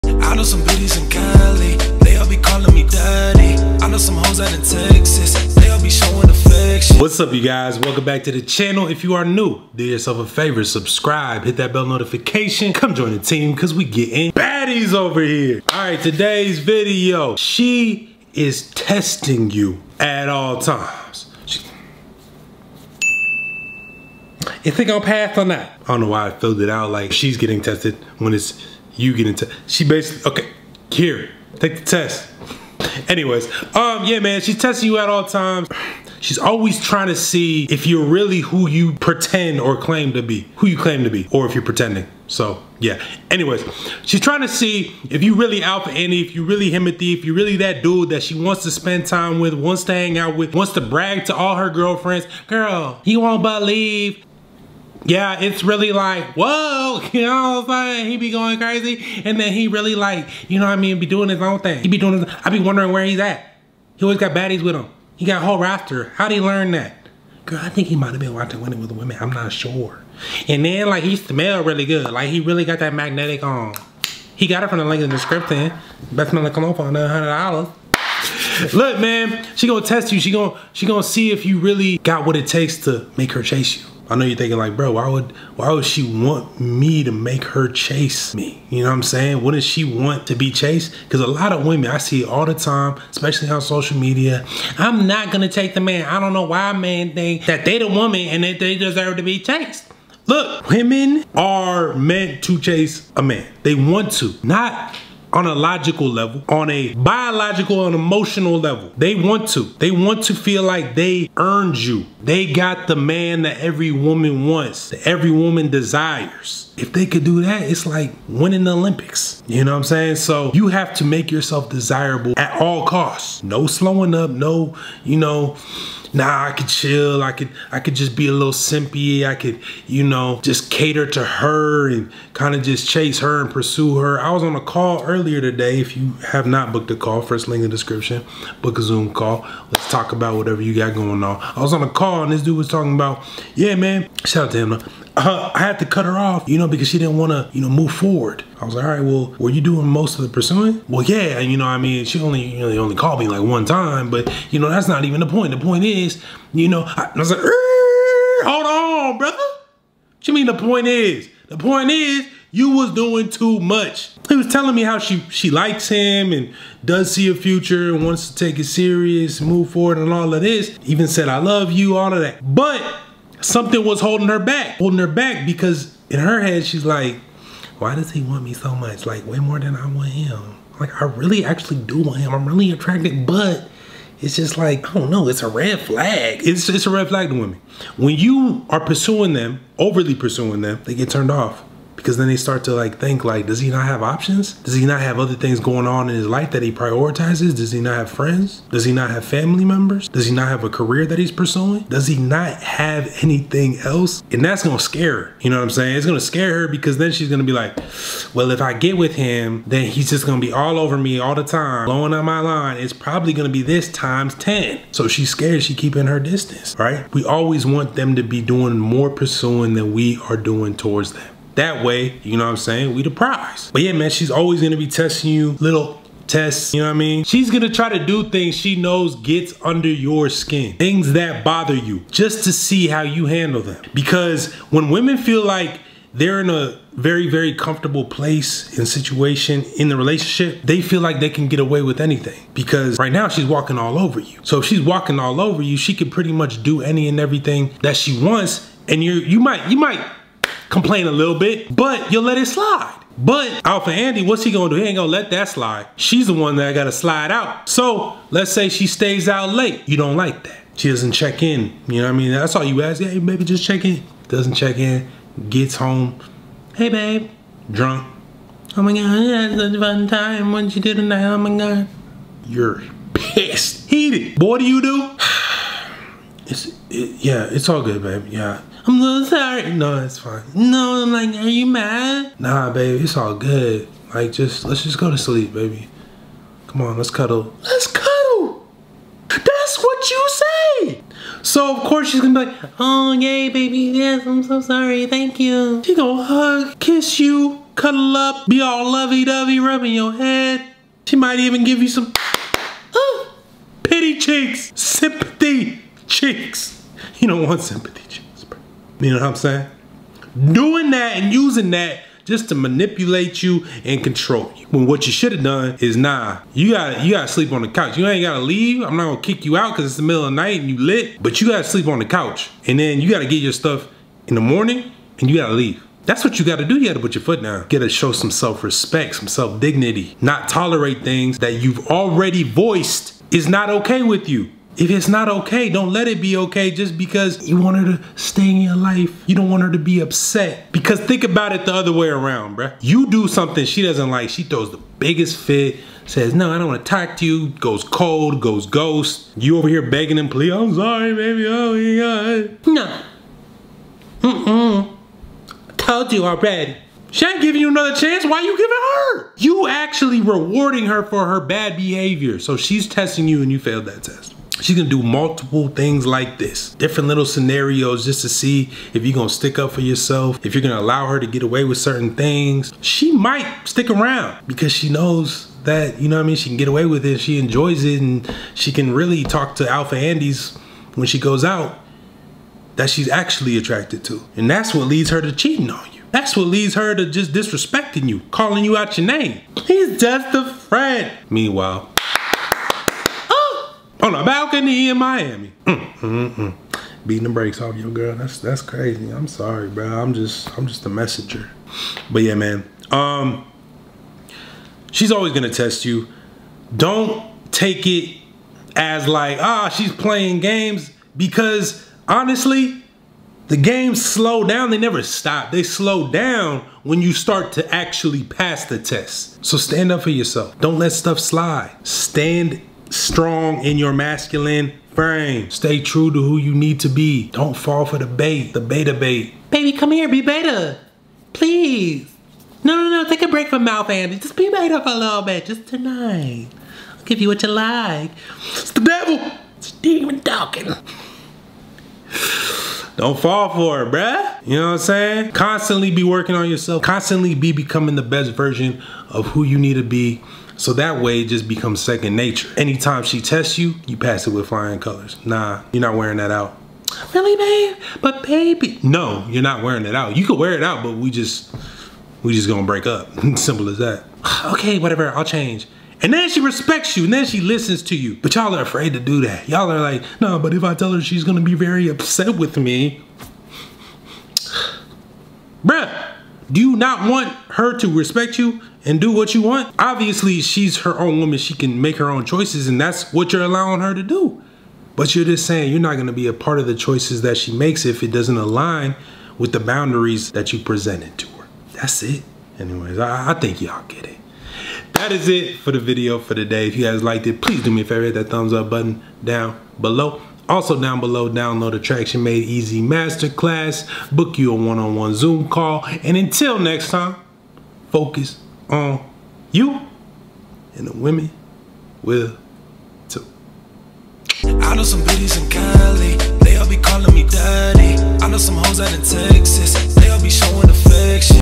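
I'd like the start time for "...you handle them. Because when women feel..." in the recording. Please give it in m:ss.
3:53.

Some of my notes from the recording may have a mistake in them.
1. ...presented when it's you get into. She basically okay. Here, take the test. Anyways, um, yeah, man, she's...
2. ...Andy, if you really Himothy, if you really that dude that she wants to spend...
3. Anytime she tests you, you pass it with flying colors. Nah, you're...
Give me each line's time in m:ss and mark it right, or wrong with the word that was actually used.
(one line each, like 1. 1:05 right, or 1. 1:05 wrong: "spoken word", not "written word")
1. 0:27 wrong: "tested", not "presented"
2. 0:45 right
3. 7:32 right.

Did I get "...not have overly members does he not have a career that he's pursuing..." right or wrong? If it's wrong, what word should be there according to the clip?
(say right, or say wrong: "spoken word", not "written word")
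wrong: "family", not "overly".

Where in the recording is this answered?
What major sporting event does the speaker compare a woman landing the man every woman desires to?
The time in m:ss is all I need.
1:58.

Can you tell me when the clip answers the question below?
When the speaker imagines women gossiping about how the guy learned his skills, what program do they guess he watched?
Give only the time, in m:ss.
1:08.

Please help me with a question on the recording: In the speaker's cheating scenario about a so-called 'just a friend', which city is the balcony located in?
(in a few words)
Miami.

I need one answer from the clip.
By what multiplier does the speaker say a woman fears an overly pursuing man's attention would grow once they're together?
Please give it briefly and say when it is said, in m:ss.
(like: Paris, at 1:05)
10, at 3:33.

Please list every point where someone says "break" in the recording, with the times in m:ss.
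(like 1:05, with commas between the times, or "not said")
7:13, 7:42.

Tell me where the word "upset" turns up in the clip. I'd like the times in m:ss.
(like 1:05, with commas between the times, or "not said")
5:39, 7:51.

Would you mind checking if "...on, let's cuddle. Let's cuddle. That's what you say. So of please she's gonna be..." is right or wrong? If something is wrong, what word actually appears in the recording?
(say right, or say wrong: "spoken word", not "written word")
wrong: "course", not "please".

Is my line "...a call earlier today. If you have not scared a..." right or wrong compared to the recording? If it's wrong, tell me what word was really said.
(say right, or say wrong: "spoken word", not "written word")
wrong: "booked", not "scared".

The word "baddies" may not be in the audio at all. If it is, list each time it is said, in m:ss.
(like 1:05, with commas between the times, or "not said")
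0:14, 1:04.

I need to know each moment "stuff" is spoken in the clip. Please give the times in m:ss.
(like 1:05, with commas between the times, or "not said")
5:23, 7:00.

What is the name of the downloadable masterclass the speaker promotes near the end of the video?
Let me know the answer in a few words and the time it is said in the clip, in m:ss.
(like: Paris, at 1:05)
Attraction Made Easy, at 8:21.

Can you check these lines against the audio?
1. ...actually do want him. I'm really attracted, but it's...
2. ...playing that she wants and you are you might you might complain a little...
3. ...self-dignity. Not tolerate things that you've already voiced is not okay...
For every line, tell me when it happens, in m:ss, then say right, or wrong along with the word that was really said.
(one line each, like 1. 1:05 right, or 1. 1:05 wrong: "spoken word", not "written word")
1. 3:01 right
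2. 4:07 wrong: "everything", not "playing"
3. 5:29 right.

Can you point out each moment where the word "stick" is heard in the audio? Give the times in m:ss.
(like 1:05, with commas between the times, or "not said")
6:09, 6:13.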